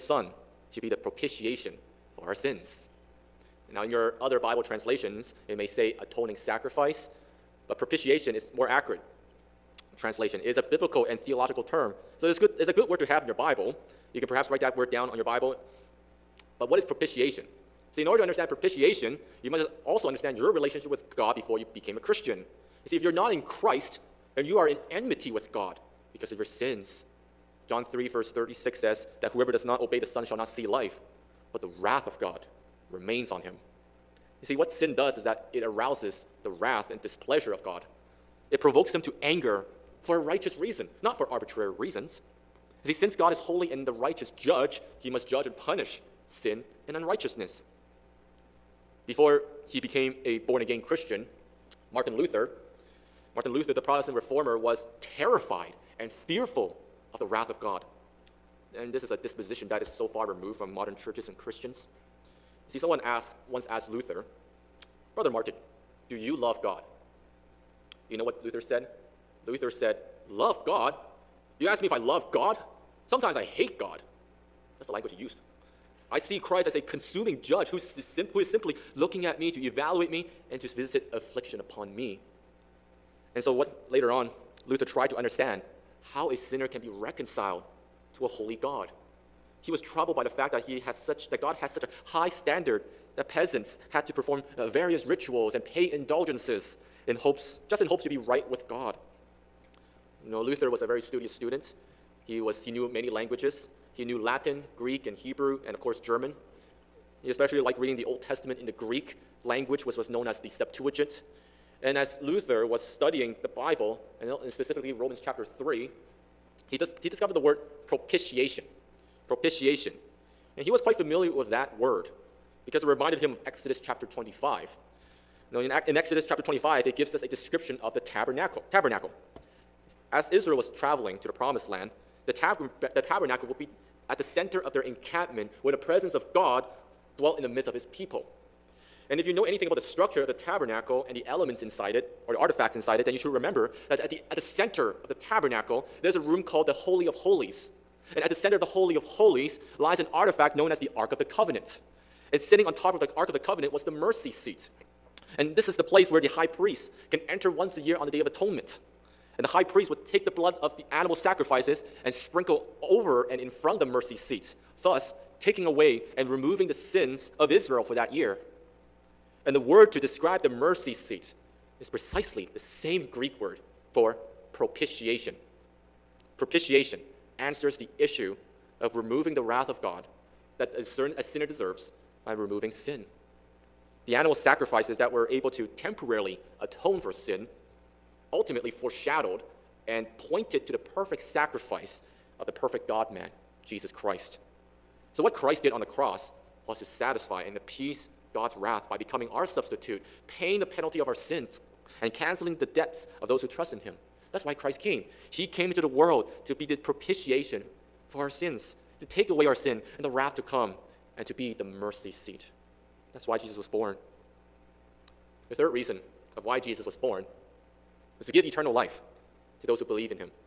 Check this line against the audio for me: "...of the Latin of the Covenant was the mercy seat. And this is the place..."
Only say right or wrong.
wrong.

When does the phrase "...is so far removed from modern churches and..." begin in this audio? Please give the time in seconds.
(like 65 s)
59 s.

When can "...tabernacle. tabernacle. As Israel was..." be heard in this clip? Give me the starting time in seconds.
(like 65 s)
127 s.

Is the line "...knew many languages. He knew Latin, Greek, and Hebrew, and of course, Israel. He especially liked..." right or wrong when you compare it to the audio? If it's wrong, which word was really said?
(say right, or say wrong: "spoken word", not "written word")
wrong: "German", not "Israel".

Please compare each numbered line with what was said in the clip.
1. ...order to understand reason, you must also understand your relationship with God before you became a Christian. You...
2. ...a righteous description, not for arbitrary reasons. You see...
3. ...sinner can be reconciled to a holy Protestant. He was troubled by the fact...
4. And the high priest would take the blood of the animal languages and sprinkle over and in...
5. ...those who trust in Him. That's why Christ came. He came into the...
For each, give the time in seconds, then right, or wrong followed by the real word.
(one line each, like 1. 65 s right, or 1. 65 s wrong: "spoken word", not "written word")
1. 18 s wrong: "propitiation", not "reason"
2. 40 s wrong: "reason", not "description"
3. 86 s wrong: "God", not "Protestant"
4. 159 s wrong: "sacrifices", not "languages"
5. 203 s right.